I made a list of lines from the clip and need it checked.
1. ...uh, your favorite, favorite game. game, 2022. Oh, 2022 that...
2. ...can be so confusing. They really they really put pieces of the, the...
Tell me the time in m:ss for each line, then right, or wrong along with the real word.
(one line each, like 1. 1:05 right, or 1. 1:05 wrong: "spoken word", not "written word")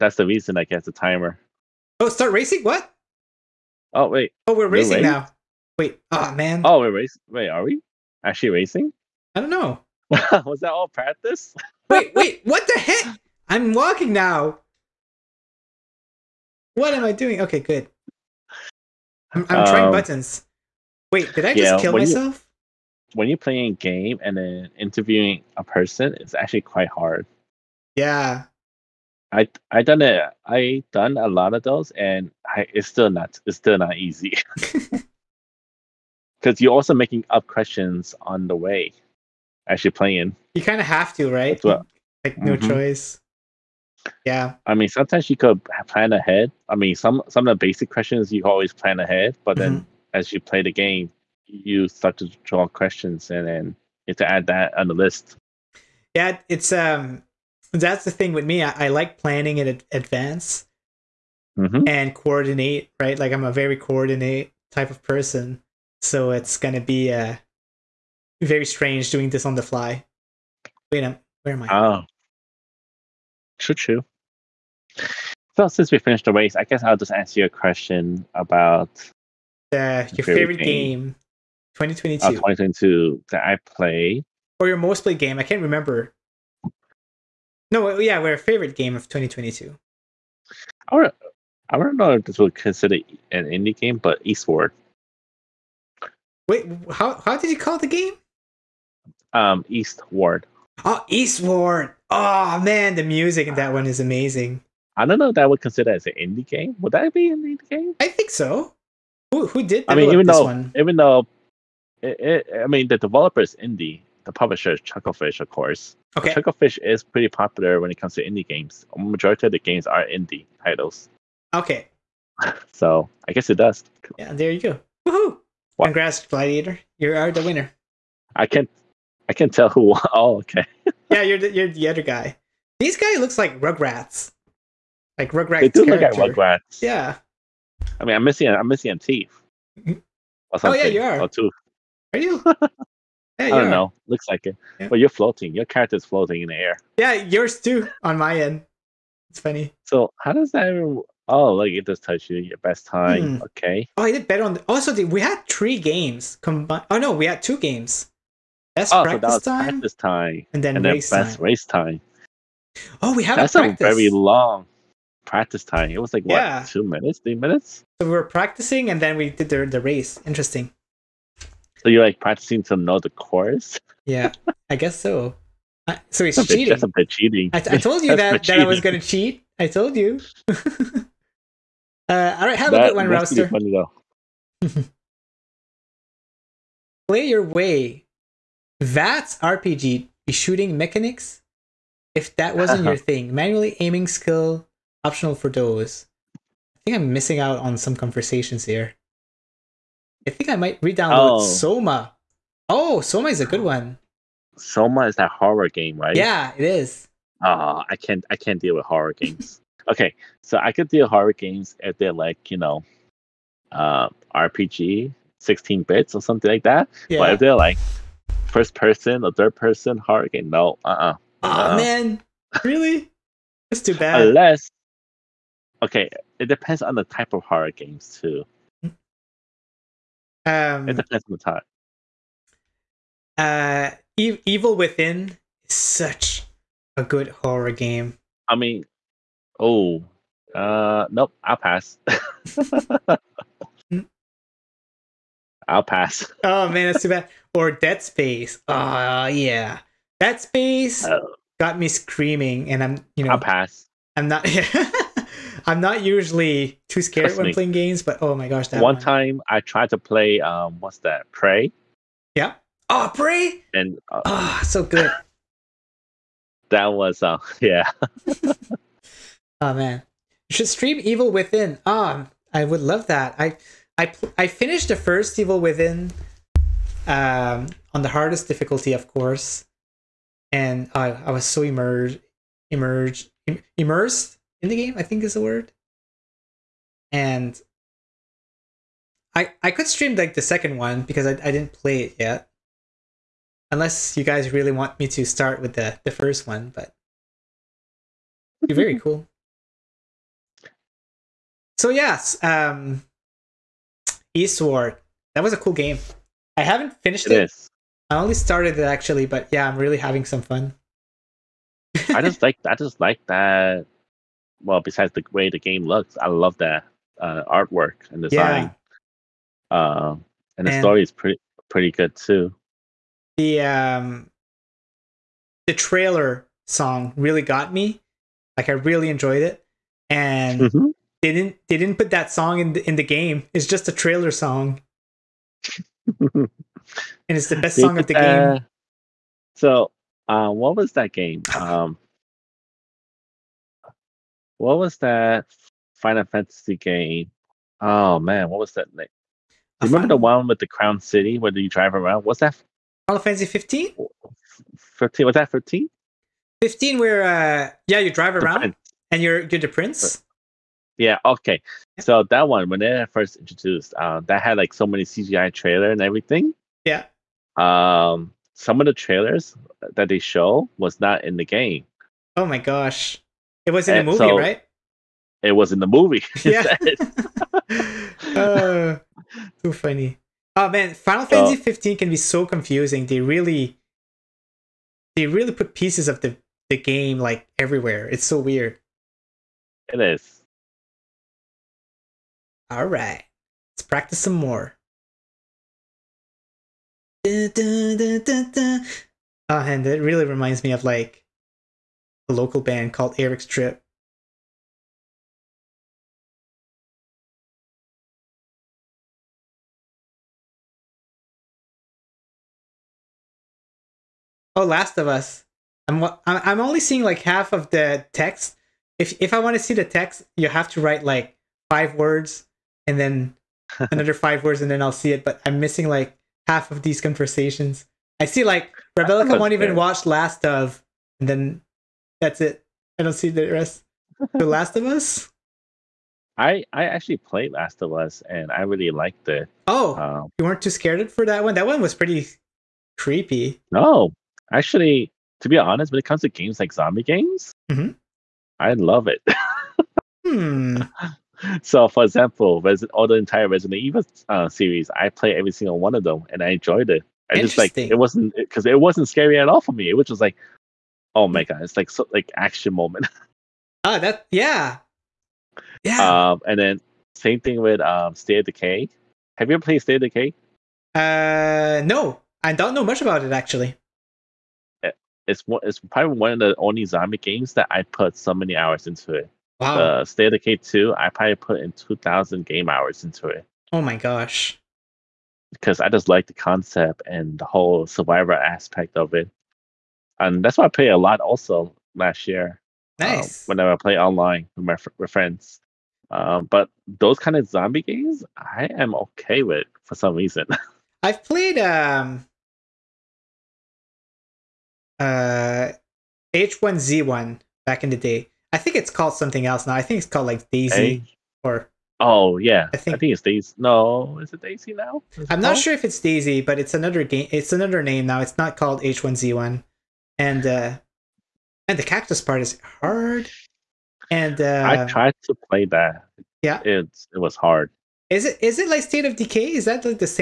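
1. 1:19 right
2. 6:21 right.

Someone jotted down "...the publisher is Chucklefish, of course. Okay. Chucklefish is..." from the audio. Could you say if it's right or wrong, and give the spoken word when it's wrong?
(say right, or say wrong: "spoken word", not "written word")
right.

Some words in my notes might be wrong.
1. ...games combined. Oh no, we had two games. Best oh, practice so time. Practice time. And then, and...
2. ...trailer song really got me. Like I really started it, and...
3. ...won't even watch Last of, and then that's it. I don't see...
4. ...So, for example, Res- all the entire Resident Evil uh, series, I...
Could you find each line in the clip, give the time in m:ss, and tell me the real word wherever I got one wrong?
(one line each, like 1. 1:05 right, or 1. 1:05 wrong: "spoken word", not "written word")
1. 2:35 right
2. 5:25 wrong: "enjoyed", not "started"
3. 7:09 right
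4. 7:31 right.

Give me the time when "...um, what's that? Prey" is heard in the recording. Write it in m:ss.
4:20.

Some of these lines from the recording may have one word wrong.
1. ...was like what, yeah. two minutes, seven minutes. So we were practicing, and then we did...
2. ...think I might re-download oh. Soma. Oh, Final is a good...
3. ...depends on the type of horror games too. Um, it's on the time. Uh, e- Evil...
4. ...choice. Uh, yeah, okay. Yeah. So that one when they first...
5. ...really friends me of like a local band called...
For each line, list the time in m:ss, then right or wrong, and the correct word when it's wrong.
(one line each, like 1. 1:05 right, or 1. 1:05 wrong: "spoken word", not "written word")
1. 2:46 wrong: "three", not "seven"
2. 3:20 wrong: "Soma", not "Final"
3. 3:46 right
4. 5:59 wrong: "prince", not "choice"
5. 6:40 wrong: "reminds", not "friends".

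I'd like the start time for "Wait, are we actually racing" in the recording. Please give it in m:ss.
0:07.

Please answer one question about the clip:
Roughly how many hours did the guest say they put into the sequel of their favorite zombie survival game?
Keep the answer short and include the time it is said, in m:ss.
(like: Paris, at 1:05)
2,000, at 8:01.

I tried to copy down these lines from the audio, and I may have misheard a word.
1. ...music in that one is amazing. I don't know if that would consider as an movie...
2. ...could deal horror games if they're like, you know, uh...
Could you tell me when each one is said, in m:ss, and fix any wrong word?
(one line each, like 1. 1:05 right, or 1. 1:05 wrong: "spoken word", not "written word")
1. 1:43 wrong: "indie", not "movie"
2. 3:30 right.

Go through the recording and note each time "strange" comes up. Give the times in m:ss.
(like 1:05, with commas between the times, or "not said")
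1:08.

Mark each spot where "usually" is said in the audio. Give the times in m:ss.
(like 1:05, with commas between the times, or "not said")
4:16.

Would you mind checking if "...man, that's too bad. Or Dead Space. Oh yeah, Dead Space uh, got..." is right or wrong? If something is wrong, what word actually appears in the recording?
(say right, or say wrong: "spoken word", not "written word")
right.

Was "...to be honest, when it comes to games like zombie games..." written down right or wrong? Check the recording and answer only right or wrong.
right.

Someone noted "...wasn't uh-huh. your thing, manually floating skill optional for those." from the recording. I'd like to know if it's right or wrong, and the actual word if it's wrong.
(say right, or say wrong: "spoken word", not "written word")
wrong: "aiming", not "floating".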